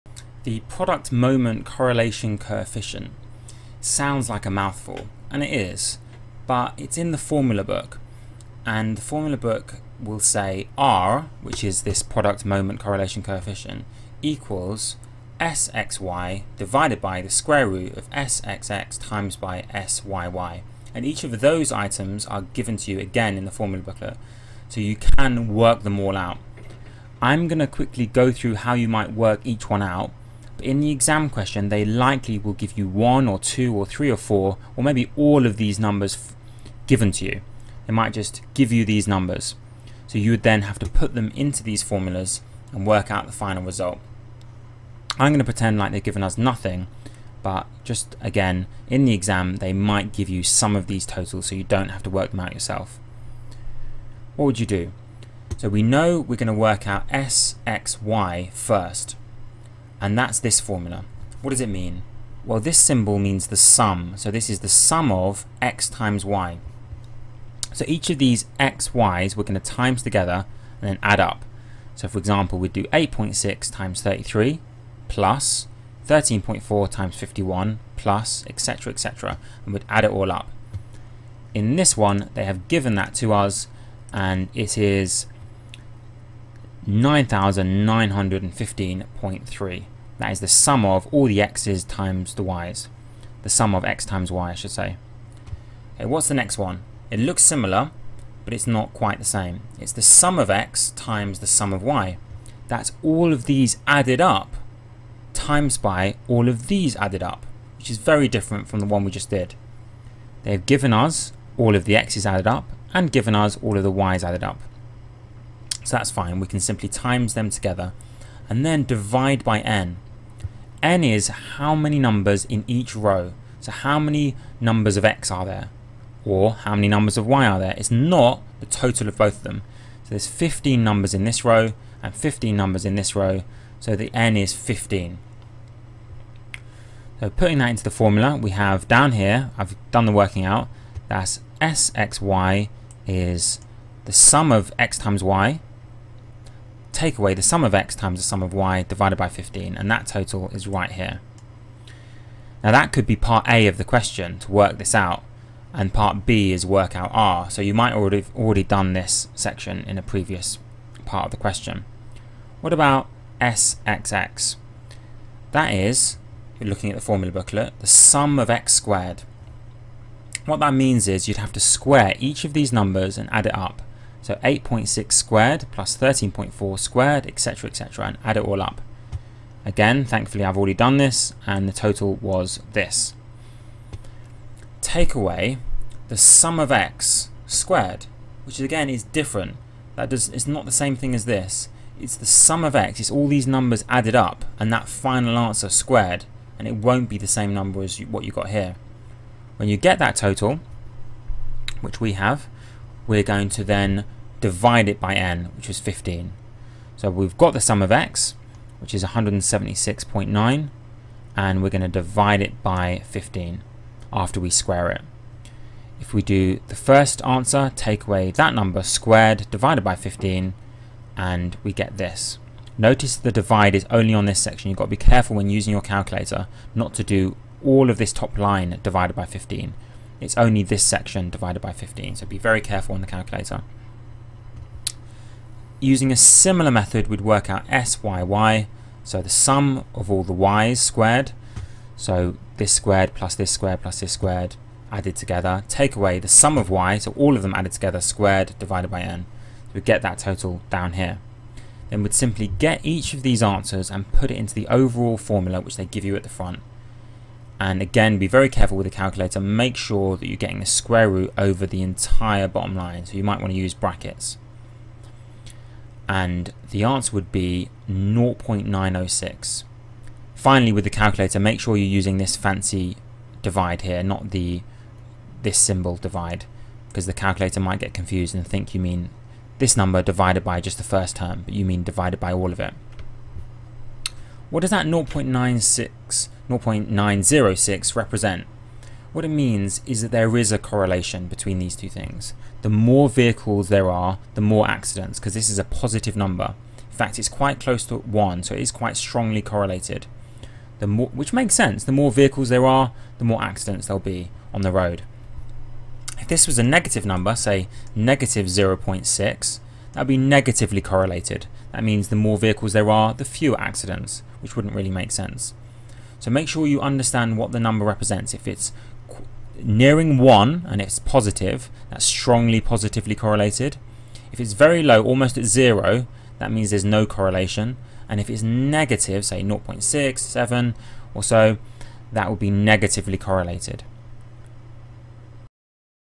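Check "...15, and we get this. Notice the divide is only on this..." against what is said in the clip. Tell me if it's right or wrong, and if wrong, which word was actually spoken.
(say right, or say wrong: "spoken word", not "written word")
right.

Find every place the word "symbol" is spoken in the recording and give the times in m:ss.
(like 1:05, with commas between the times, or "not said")
1:02, 4:35.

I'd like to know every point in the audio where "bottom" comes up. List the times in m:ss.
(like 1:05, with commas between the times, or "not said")
4:22.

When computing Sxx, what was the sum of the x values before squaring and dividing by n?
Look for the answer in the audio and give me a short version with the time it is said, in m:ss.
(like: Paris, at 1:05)
176.9, at 3:29.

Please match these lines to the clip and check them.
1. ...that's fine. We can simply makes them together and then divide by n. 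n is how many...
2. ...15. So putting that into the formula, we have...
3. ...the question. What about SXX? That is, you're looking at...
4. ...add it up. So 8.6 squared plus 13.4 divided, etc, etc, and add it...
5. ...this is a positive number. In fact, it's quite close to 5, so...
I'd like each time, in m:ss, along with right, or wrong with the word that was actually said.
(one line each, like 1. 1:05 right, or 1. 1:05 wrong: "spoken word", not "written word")
1. 1:55 wrong: "times", not "makes"
2. 2:14 right
3. 2:41 right
4. 2:53 wrong: "squared", not "divided"
5. 4:55 wrong: "1", not "5".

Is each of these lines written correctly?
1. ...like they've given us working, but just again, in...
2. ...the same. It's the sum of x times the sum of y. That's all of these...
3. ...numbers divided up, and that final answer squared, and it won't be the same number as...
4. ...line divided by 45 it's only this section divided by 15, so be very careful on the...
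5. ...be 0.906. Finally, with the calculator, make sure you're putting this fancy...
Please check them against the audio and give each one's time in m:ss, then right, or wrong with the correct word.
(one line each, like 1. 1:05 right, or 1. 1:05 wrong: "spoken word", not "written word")
1. 0:45 wrong: "nothing", not "working"
2. 1:39 right
3. 3:13 wrong: "added", not "divided"
4. 3:48 wrong: "15", not "45"
5. 4:27 wrong: "using", not "putting".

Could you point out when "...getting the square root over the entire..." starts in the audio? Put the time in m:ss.
4:20.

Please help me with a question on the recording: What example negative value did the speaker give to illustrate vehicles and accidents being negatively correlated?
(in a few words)
-0.6.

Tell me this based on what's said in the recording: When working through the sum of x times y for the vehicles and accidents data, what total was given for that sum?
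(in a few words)
9,915.3.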